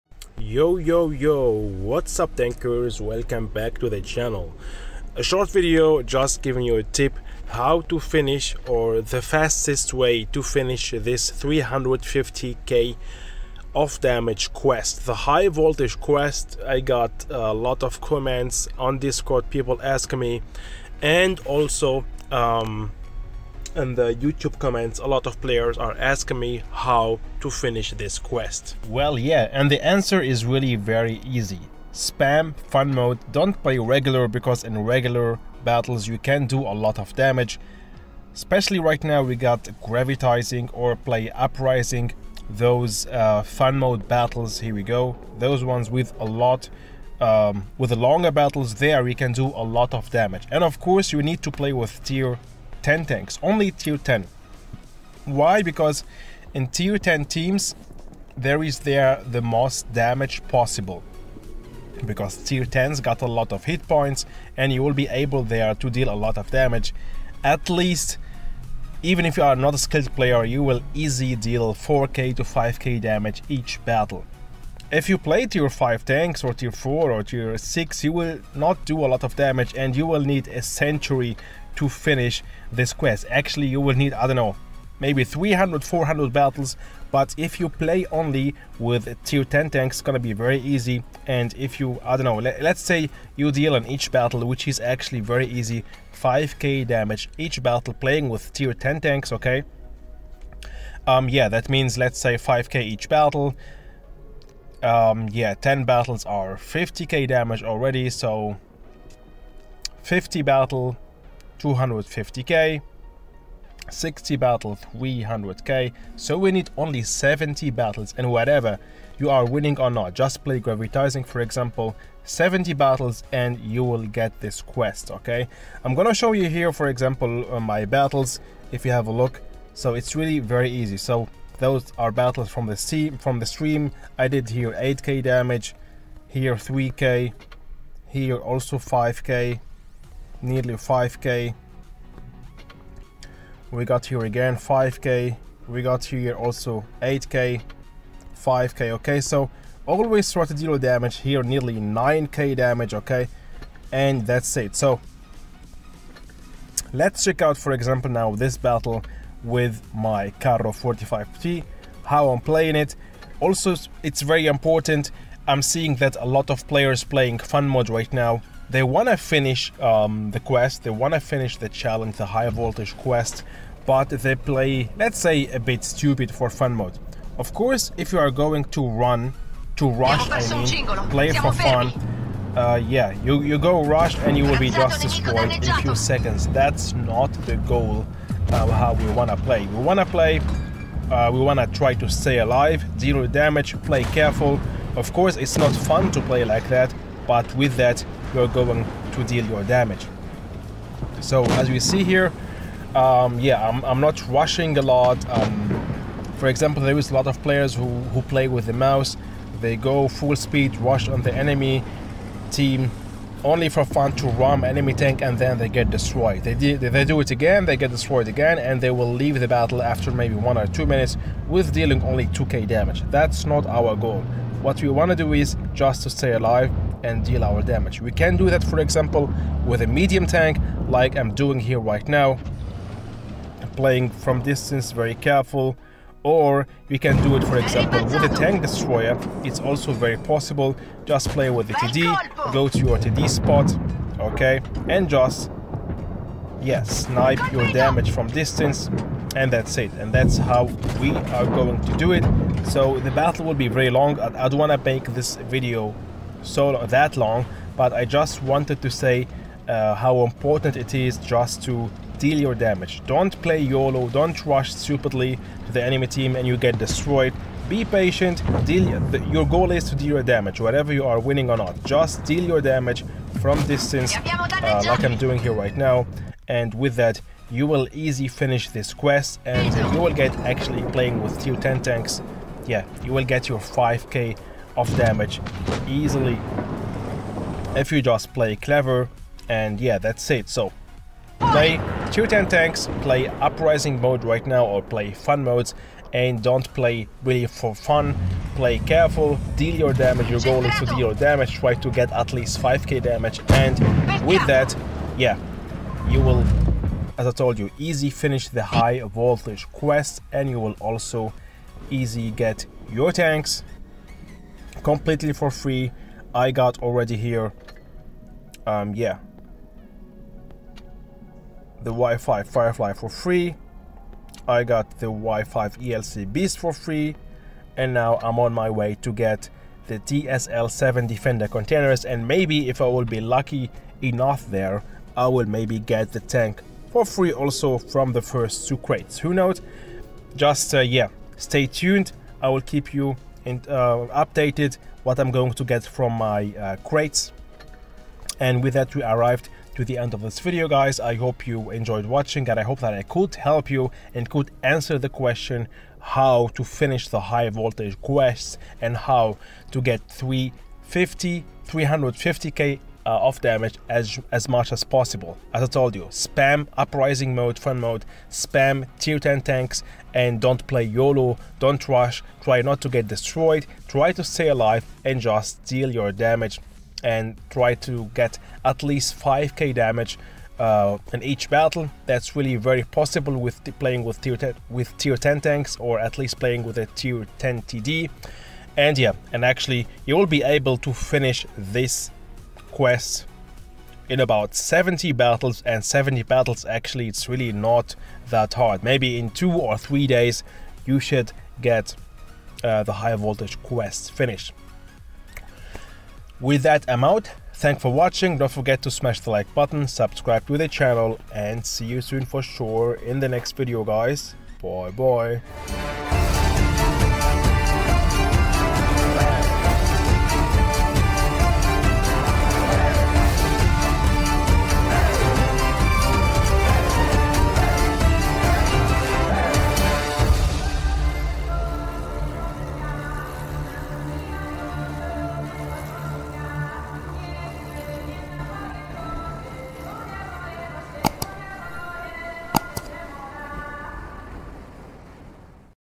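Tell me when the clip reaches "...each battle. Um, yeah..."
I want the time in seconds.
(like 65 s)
102 s.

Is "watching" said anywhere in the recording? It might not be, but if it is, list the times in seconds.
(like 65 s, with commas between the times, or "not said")
352 s, 407 s.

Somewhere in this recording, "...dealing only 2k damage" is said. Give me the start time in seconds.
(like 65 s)
221 s.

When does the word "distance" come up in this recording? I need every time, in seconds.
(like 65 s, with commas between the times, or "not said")
234 s, 248 s, 273 s.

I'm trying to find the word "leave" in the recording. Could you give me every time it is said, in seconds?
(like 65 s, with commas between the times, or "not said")
219 s.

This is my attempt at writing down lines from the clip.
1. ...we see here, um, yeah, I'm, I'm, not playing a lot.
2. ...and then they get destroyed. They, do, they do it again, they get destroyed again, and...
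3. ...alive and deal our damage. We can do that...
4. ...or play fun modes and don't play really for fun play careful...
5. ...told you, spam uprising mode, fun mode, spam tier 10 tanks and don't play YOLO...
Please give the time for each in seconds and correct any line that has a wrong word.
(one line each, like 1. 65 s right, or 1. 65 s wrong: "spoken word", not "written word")
1. 201 s wrong: "rushing", not "playing"
2. 215 s right
3. 226 s right
4. 294 s right
5. 365 s right.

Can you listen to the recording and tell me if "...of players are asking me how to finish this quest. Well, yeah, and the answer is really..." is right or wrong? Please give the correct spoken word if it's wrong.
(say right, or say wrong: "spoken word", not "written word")
right.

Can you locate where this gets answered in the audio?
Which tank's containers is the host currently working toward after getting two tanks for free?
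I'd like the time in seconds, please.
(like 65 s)
329 s.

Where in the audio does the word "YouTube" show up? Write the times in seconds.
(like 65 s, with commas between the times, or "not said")
24 s.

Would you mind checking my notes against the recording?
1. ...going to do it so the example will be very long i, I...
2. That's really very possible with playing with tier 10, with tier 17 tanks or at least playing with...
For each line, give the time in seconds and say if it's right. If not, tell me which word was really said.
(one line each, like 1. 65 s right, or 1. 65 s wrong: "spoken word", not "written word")
1. 251 s wrong: "battle", not "example"
2. 382 s wrong: "10", not "17".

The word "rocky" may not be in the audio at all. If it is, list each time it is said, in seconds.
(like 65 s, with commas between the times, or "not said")
not said.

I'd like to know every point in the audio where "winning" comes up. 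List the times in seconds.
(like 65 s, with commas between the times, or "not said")
119 s, 271 s.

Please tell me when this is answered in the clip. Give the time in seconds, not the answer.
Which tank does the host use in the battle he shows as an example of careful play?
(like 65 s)
160 s.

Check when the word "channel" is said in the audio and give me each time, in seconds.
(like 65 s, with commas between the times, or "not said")
4 s, 410 s.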